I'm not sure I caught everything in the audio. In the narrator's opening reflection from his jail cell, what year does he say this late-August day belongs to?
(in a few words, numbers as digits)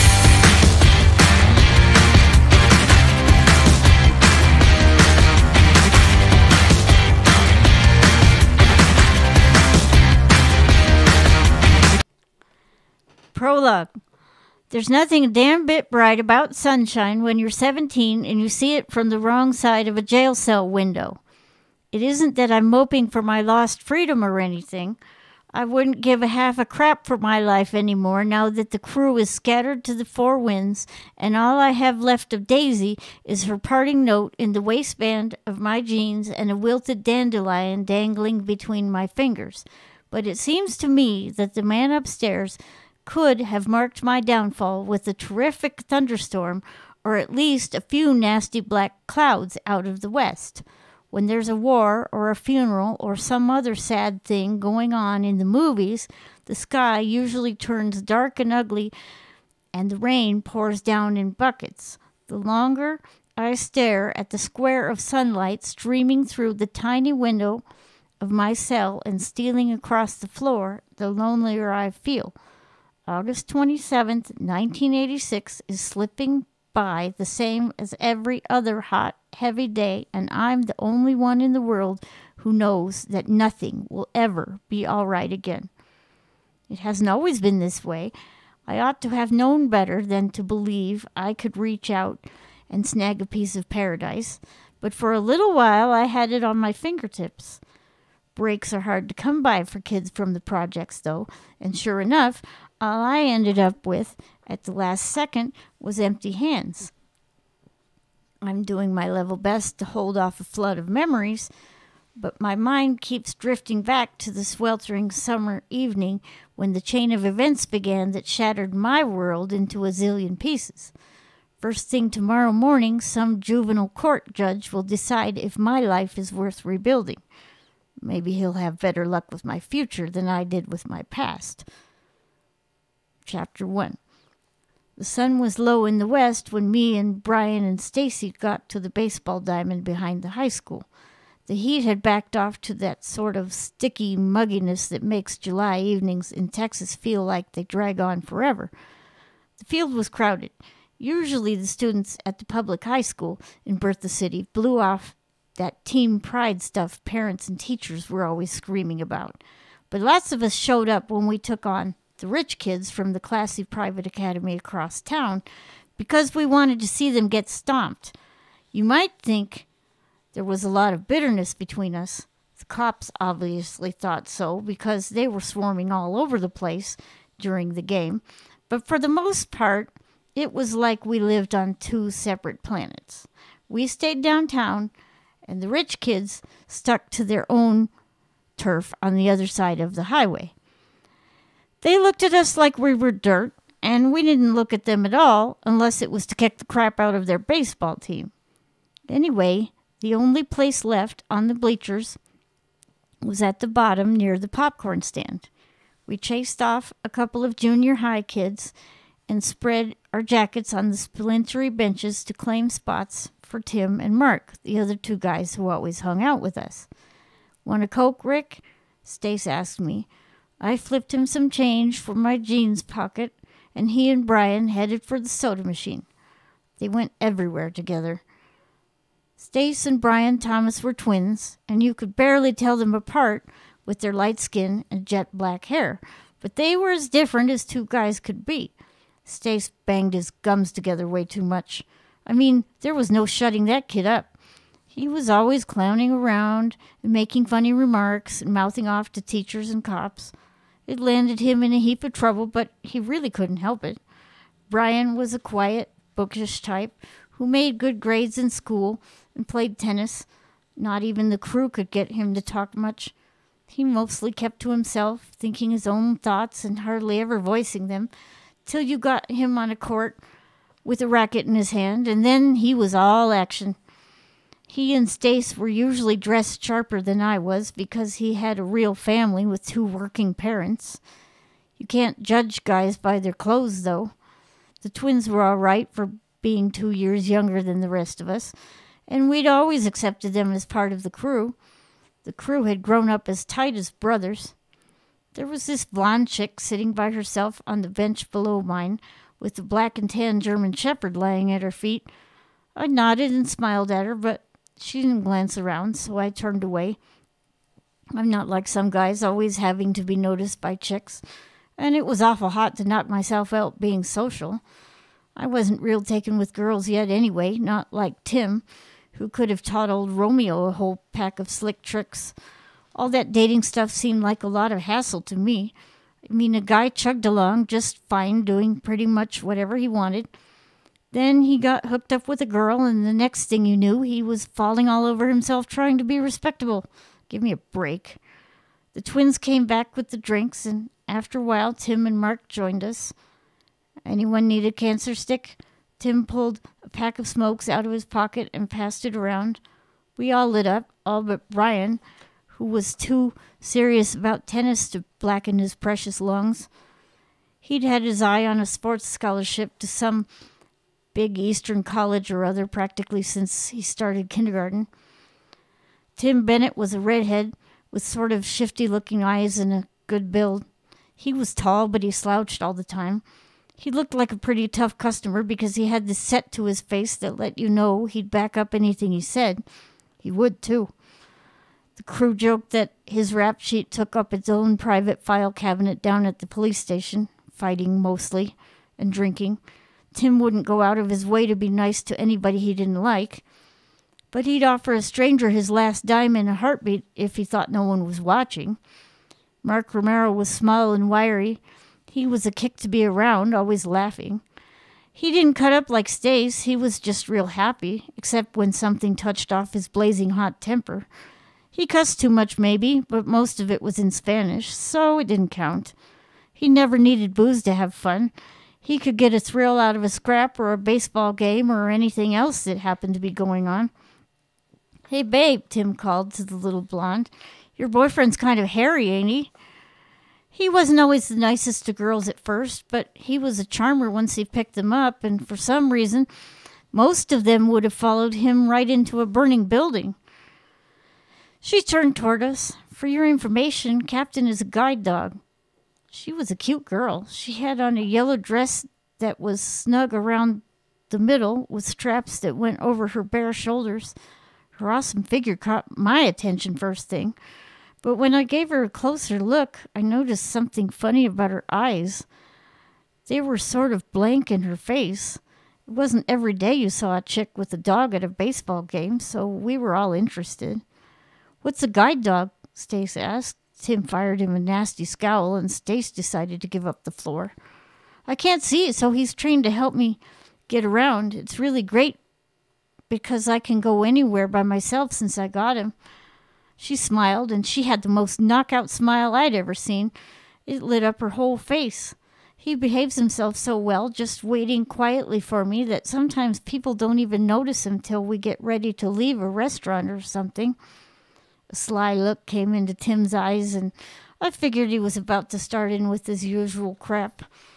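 1986.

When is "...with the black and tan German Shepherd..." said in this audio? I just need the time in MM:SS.
04:59.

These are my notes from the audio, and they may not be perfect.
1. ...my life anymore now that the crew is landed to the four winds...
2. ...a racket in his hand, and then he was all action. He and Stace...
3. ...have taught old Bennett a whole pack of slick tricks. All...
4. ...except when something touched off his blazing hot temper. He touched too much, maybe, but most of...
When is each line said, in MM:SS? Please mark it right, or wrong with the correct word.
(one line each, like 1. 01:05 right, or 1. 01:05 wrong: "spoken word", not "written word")
1. 00:27 wrong: "scattered", not "landed"
2. 04:31 right
3. 05:19 wrong: "Romeo", not "Bennett"
4. 06:48 wrong: "cussed", not "touched".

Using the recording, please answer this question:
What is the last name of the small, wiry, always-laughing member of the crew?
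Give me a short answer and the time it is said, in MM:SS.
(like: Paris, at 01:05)
Romero, at 06:39.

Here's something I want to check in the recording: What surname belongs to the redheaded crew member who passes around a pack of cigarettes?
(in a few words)
Bennett.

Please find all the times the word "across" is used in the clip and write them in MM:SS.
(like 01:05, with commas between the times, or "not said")
01:09, 02:44.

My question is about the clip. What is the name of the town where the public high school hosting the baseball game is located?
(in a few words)
Bertha City.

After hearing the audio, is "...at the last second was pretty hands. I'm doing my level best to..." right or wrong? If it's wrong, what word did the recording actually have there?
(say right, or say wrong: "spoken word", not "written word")
wrong: "empty", not "pretty".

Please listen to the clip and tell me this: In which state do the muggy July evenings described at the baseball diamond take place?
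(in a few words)
Texas.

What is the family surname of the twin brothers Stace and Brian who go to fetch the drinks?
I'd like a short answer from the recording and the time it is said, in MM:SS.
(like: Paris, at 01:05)
Thomas, at 03:50.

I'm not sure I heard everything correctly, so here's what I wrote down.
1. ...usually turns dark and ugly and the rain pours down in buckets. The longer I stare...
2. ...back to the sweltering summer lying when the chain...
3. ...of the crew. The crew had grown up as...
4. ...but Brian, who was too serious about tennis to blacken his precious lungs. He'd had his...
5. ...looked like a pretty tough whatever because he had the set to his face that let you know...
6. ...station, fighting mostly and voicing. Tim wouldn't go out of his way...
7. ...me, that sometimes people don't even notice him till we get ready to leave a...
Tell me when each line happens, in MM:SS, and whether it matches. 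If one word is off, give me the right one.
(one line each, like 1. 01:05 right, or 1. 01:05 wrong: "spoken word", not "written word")
1. 00:56 right
2. 01:53 wrong: "evening", not "lying"
3. 04:50 right
4. 05:51 right
5. 06:13 wrong: "customer", not "whatever"
6. 06:26 wrong: "drinking", not "voicing"
7. 08:15 right.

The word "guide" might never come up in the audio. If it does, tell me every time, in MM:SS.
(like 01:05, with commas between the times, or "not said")
07:24, 07:51.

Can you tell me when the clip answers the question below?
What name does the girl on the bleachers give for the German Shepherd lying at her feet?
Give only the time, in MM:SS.
07:24.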